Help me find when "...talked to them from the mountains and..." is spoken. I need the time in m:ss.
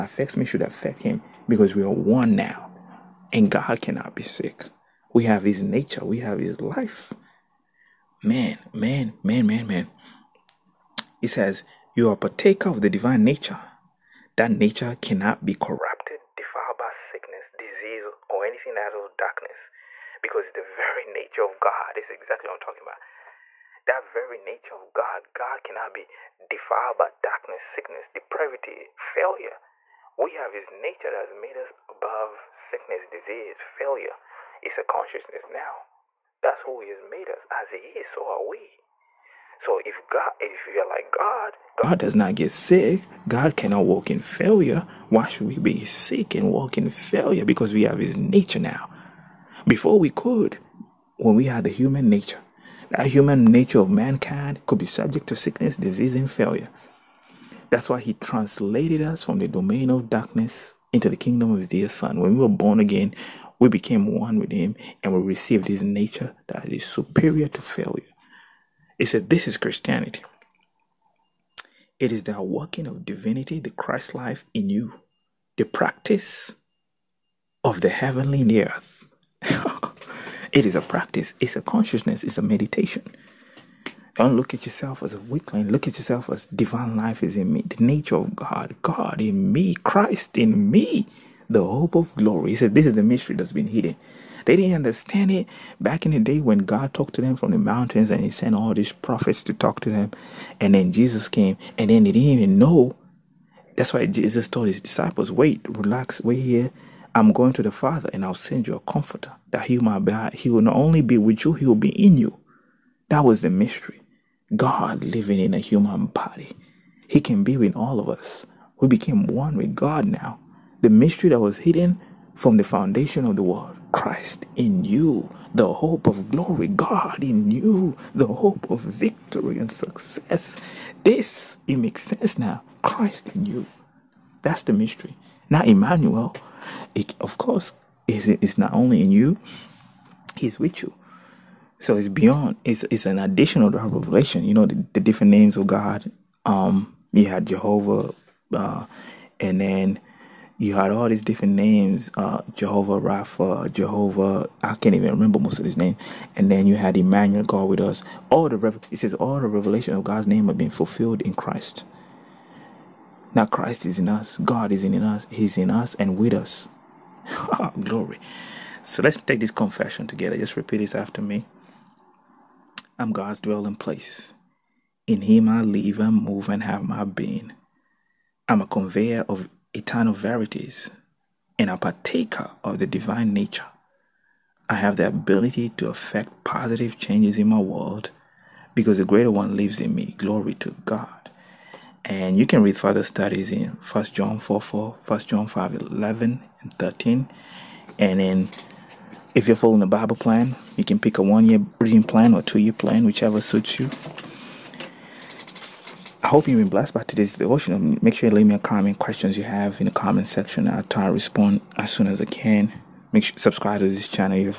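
1:36.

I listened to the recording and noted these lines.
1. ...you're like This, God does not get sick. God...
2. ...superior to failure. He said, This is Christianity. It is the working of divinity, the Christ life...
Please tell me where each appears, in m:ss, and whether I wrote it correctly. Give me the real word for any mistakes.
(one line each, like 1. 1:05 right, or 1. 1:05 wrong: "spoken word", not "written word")
1. 0:40 wrong: "God", not "This"
2. 1:06 right.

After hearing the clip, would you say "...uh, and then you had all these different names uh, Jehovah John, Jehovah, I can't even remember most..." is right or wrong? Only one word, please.
wrong.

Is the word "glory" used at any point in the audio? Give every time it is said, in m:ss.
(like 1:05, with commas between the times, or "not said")
1:32, 2:06, 2:47, 3:10.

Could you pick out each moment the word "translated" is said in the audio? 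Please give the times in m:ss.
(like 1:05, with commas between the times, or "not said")
0:58.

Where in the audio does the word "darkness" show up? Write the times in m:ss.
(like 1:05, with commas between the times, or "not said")
0:19, 0:27, 1:00.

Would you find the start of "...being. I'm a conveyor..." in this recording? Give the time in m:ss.
2:57.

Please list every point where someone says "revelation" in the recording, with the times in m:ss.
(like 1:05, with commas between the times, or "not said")
2:23, 2:39.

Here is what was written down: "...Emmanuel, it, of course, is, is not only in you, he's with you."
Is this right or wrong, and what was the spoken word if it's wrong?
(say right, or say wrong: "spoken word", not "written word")
right.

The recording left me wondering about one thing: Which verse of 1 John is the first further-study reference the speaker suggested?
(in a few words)
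1 John 4:4.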